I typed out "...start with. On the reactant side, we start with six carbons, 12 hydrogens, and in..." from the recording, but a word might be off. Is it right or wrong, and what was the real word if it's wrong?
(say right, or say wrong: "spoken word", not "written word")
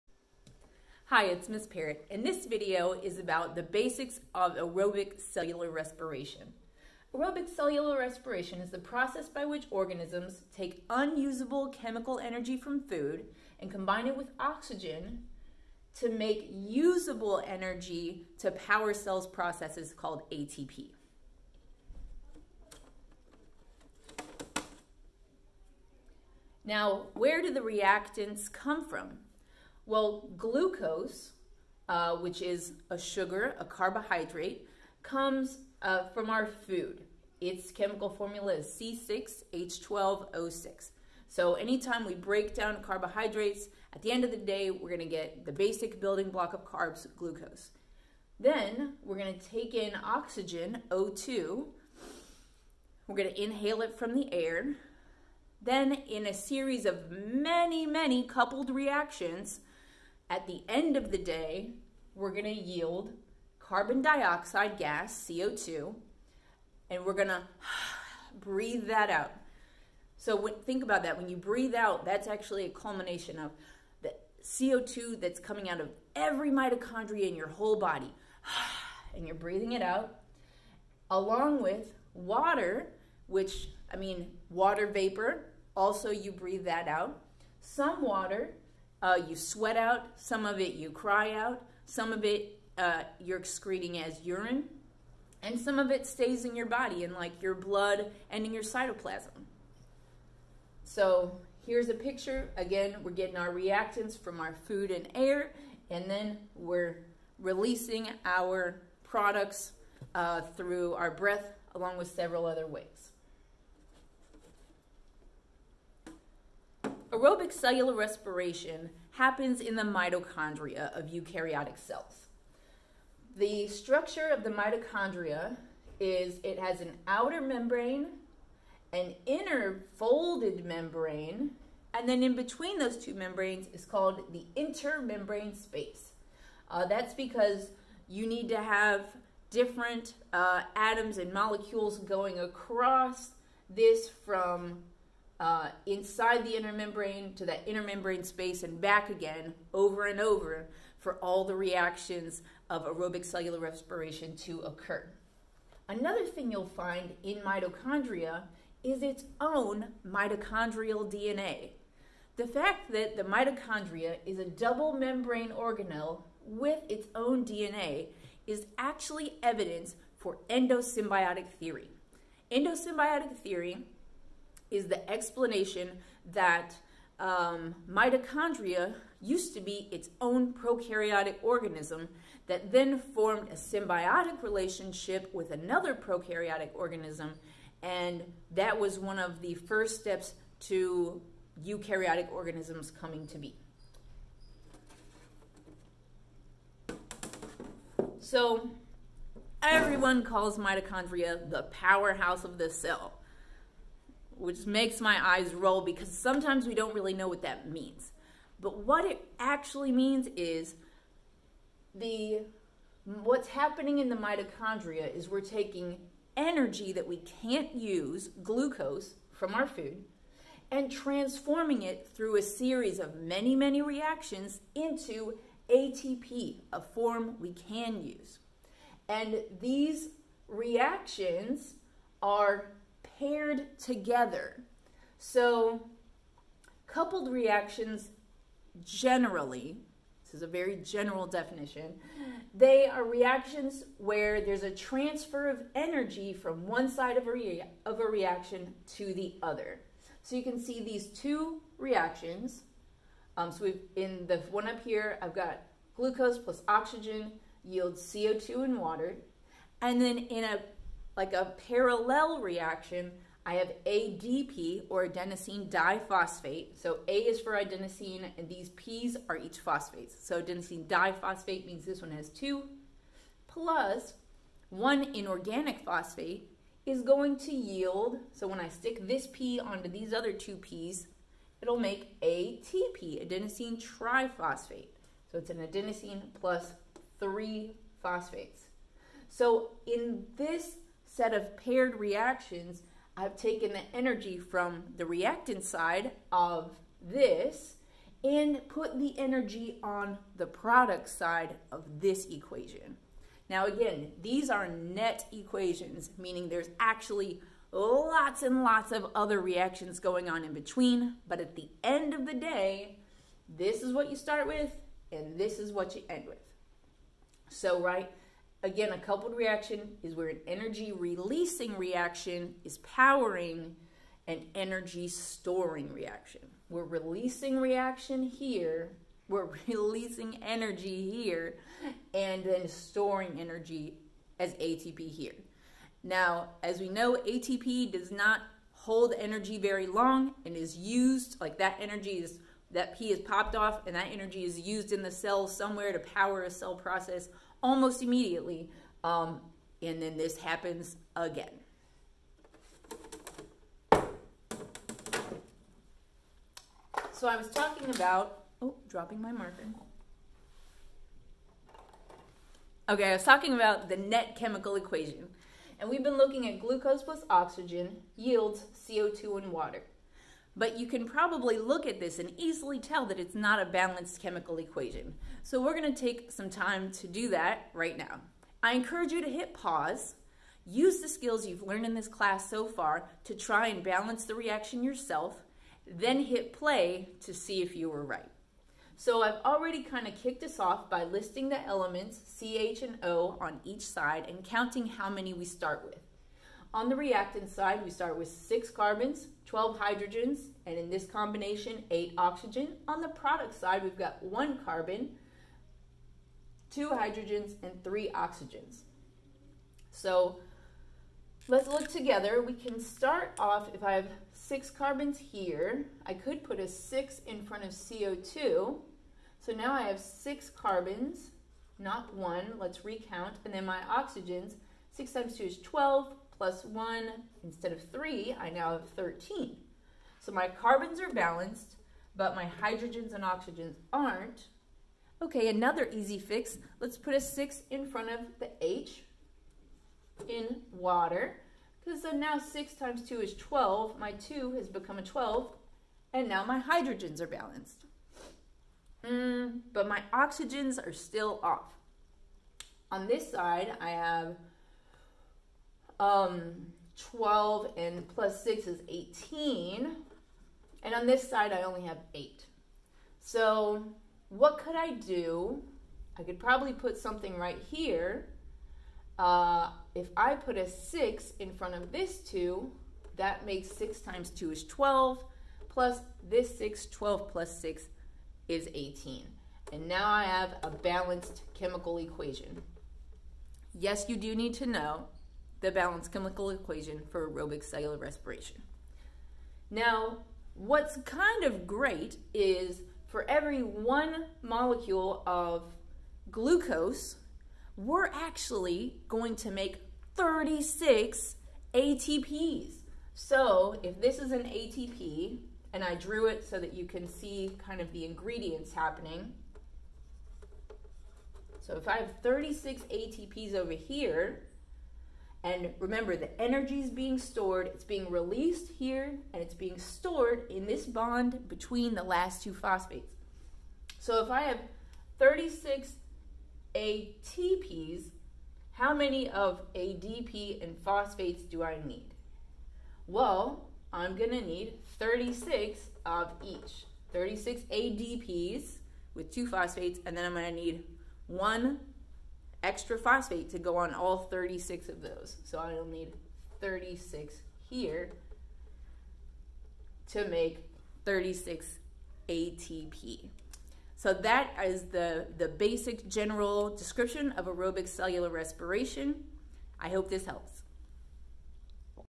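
right.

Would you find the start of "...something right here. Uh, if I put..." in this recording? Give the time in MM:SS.
07:46.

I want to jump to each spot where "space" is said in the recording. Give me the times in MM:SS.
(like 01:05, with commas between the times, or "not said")
02:15, 02:28.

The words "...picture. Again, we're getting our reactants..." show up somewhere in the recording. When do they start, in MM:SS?
01:41.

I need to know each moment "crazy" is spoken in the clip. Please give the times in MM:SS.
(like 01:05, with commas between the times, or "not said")
not said.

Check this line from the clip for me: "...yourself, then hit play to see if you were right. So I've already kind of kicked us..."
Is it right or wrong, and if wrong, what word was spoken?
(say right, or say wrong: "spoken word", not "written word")
right.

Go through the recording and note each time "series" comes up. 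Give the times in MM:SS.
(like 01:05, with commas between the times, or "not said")
00:56, 03:42.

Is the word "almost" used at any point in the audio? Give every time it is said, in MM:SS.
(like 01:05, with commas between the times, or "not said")
05:47.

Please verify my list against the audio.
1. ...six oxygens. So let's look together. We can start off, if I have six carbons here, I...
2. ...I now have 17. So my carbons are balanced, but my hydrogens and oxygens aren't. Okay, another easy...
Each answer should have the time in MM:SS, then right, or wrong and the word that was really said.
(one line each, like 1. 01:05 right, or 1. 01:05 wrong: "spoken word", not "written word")
1. 06:47 wrong: "three", not "six"
2. 07:08 wrong: "13", not "17".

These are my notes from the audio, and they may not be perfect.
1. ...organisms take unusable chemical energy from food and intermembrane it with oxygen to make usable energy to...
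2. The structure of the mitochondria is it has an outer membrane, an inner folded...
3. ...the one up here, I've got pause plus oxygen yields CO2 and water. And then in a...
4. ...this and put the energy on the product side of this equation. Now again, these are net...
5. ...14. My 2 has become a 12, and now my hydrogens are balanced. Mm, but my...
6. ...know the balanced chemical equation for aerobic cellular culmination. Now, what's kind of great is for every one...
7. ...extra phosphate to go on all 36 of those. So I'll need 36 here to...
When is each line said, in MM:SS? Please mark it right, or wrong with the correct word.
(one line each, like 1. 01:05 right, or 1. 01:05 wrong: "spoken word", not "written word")
1. 00:09 wrong: "combine", not "intermembrane"
2. 02:03 right
3. 04:14 wrong: "glucose", not "pause"
4. 04:57 right
5. 07:23 wrong: "12", not "14"
6. 08:04 wrong: "respiration", not "culmination"
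7. 09:02 right.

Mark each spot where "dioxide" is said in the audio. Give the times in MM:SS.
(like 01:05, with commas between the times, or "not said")
01:04.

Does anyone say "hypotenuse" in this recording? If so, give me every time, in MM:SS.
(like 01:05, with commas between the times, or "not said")
not said.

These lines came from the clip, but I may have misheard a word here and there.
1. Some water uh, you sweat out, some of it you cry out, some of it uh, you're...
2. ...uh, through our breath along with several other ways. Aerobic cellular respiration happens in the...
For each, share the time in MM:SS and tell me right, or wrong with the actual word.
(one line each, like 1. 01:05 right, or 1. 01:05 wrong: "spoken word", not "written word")
1. 01:27 right
2. 01:50 right.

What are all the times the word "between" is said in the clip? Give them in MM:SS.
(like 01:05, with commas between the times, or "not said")
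02:12, 05:10, 08:41.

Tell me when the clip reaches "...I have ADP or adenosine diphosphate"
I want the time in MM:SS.
04:23.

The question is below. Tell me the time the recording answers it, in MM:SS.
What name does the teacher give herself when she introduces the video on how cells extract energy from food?
00:01.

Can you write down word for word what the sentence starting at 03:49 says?
And these reactions are paired together.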